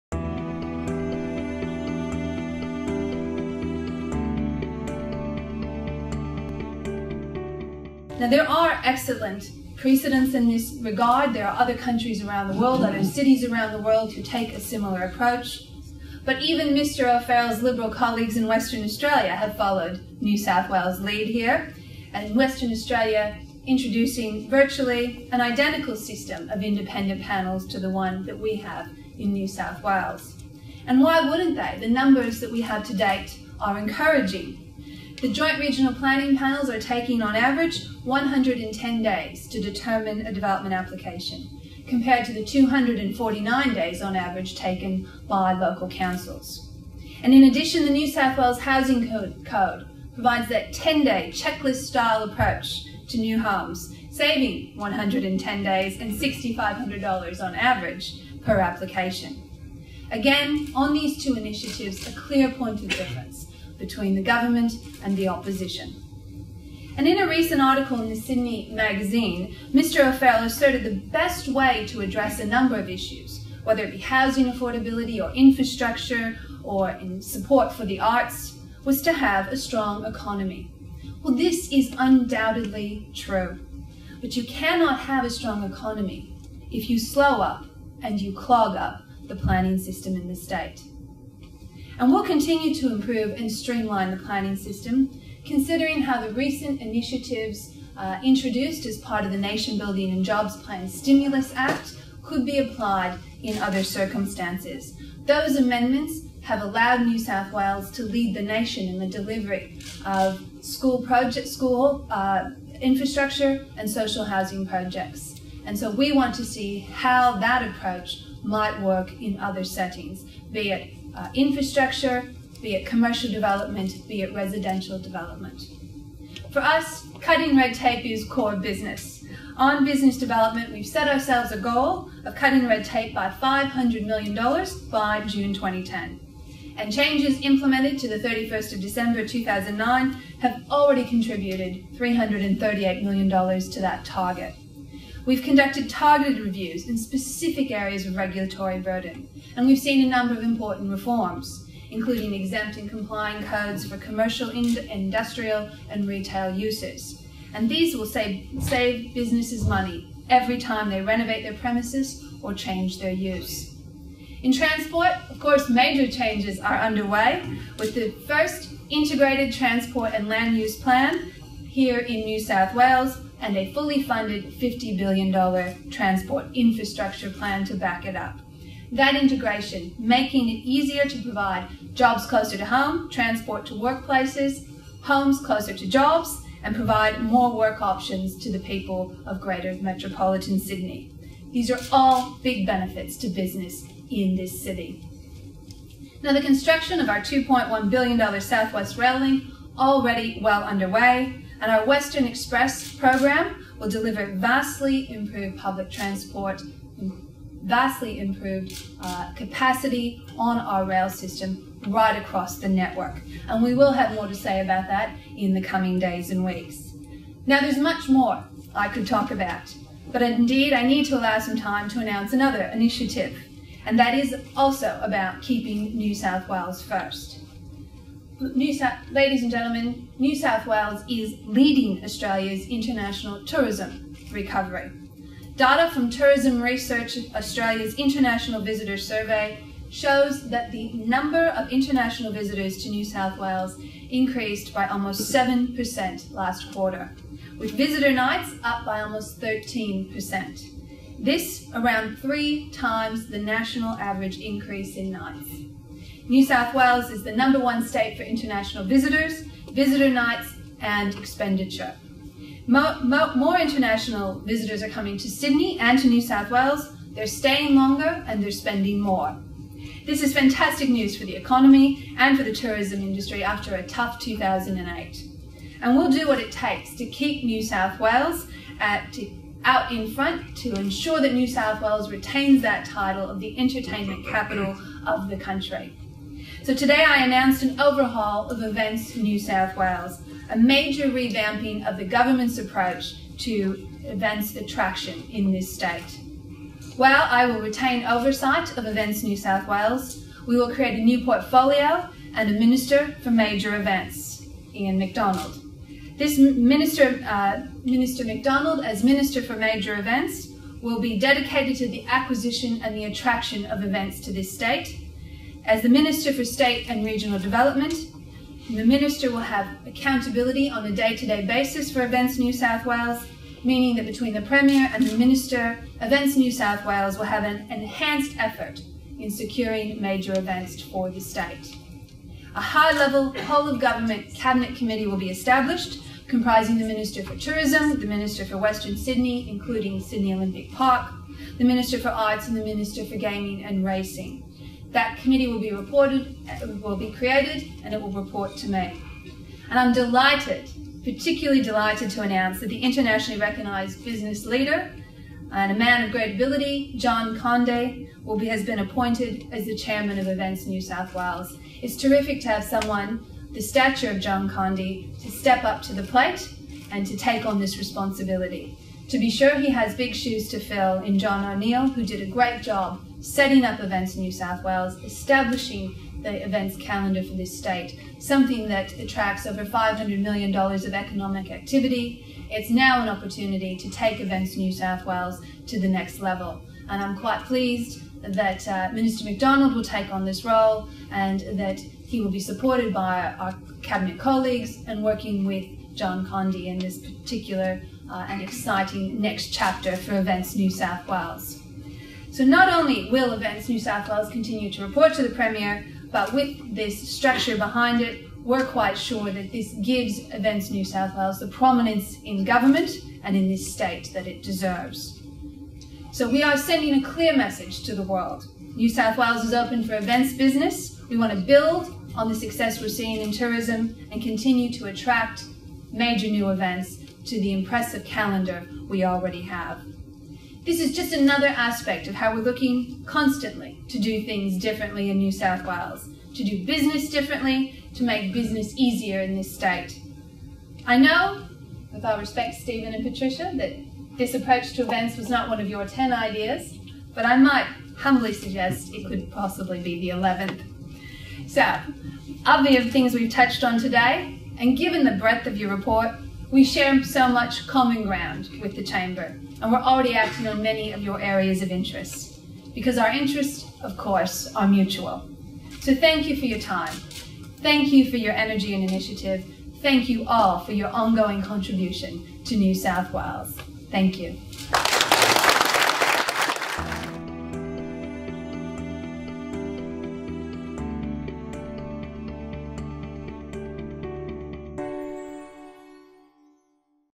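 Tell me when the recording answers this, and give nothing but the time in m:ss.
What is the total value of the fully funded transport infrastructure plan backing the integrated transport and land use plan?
2:54.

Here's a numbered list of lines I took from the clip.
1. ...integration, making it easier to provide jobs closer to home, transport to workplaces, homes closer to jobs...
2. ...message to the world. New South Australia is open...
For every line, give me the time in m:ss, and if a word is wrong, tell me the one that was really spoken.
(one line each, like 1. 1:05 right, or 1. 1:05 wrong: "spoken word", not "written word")
1. 2:59 right
2. 6:57 wrong: "Wales", not "Australia".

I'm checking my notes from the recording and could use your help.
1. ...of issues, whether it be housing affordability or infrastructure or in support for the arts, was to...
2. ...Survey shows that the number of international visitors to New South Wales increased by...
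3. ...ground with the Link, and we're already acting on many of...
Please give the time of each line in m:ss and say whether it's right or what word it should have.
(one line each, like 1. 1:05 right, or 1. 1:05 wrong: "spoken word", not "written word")
1. 1:12 right
2. 3:58 right
3. 7:38 wrong: "Chamber", not "Link".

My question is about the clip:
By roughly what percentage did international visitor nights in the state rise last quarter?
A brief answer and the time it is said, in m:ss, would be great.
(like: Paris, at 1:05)
13%, at 4:09.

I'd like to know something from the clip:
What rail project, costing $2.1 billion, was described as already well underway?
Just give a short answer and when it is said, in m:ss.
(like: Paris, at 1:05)
Southwest Rail Link, at 3:18.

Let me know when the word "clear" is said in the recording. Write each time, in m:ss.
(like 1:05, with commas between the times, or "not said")
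1:02, 6:57.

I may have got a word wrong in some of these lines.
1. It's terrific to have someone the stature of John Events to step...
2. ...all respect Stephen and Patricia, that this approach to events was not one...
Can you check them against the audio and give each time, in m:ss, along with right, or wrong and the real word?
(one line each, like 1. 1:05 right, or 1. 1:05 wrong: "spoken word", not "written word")
1. 6:01 wrong: "Conde", not "Events"
2. 7:22 right.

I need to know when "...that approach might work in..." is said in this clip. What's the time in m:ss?
1:57.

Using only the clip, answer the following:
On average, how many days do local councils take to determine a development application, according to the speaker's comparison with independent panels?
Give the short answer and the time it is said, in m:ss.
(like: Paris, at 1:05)
249 days, at 0:42.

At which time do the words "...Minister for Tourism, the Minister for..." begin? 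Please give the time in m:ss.
5:36.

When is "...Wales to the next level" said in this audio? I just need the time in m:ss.
6:25.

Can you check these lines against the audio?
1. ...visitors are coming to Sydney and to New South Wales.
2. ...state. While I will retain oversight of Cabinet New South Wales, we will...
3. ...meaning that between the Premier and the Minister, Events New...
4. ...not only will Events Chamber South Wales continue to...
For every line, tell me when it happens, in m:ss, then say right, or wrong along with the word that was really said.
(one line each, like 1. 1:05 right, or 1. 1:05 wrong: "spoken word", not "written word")
1. 4:24 right
2. 4:55 wrong: "Events", not "Cabinet"
3. 5:23 right
4. 6:42 wrong: "New", not "Chamber".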